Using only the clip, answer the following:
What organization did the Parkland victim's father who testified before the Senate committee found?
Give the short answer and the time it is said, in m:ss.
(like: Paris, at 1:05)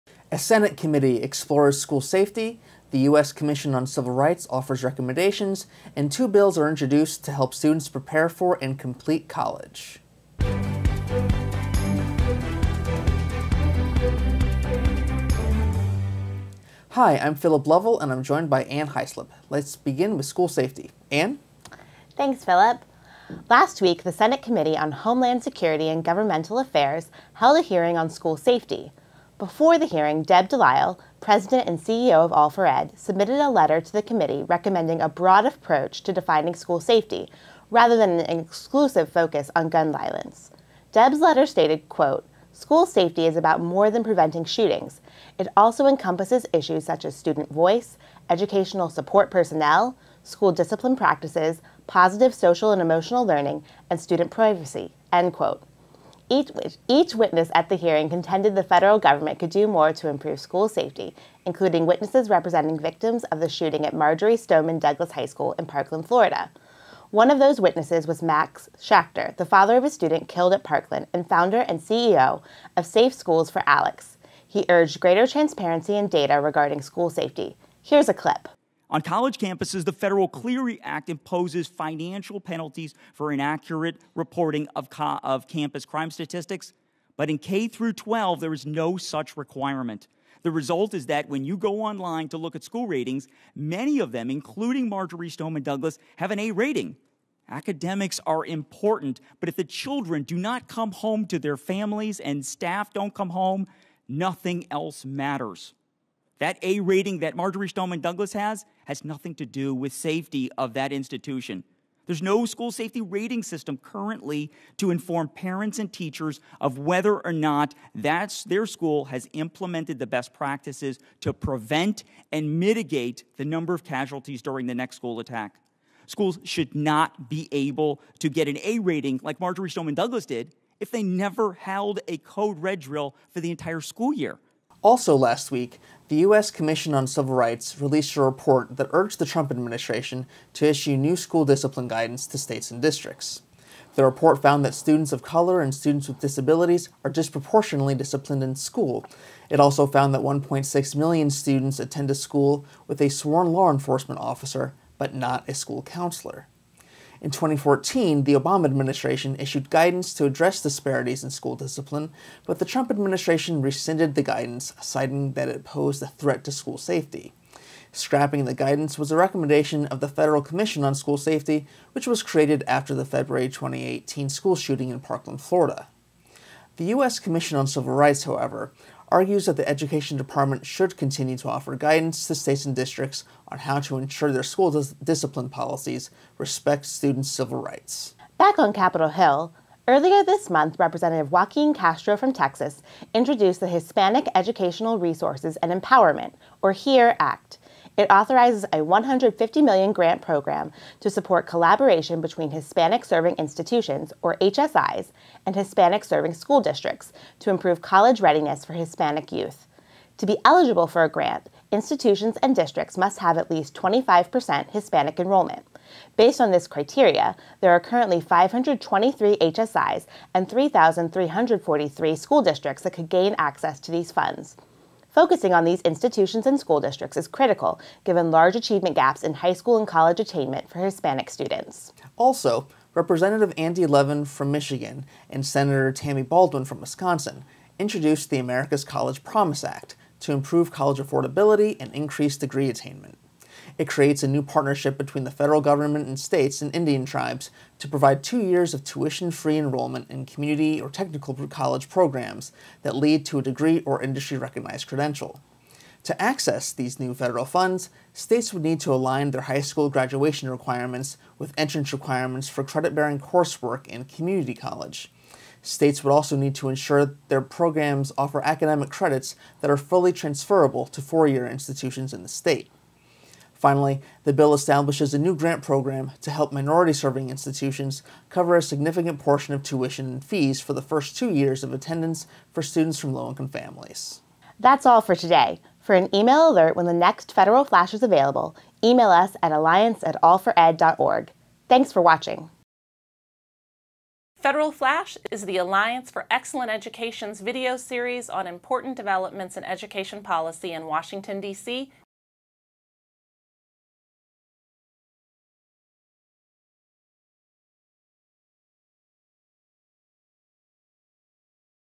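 Safe Schools for Alex, at 1:12.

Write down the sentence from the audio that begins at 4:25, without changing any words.
States would also need to ensure their programs offer academic credits that are fully transferable to four-year institutions in the state.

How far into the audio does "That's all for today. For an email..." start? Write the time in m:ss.
4:44.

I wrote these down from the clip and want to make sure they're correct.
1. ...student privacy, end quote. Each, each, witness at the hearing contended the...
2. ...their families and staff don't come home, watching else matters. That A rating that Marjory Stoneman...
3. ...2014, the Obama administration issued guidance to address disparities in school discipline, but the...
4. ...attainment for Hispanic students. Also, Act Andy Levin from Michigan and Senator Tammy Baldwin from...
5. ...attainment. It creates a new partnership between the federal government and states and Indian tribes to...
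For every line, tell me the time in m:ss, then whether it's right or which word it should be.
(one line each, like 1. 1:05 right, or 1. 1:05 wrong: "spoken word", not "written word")
1. 0:53 right
2. 1:41 wrong: "nothing", not "watching"
3. 2:37 right
4. 3:50 wrong: "Representative", not "Act"
5. 4:02 right.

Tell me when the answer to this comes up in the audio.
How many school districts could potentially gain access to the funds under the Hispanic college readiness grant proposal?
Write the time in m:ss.
3:40.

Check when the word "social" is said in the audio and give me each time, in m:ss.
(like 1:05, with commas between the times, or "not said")
0:52.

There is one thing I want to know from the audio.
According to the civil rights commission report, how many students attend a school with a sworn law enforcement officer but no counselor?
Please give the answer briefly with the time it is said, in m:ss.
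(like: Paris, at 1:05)
1.6 million, at 2:30.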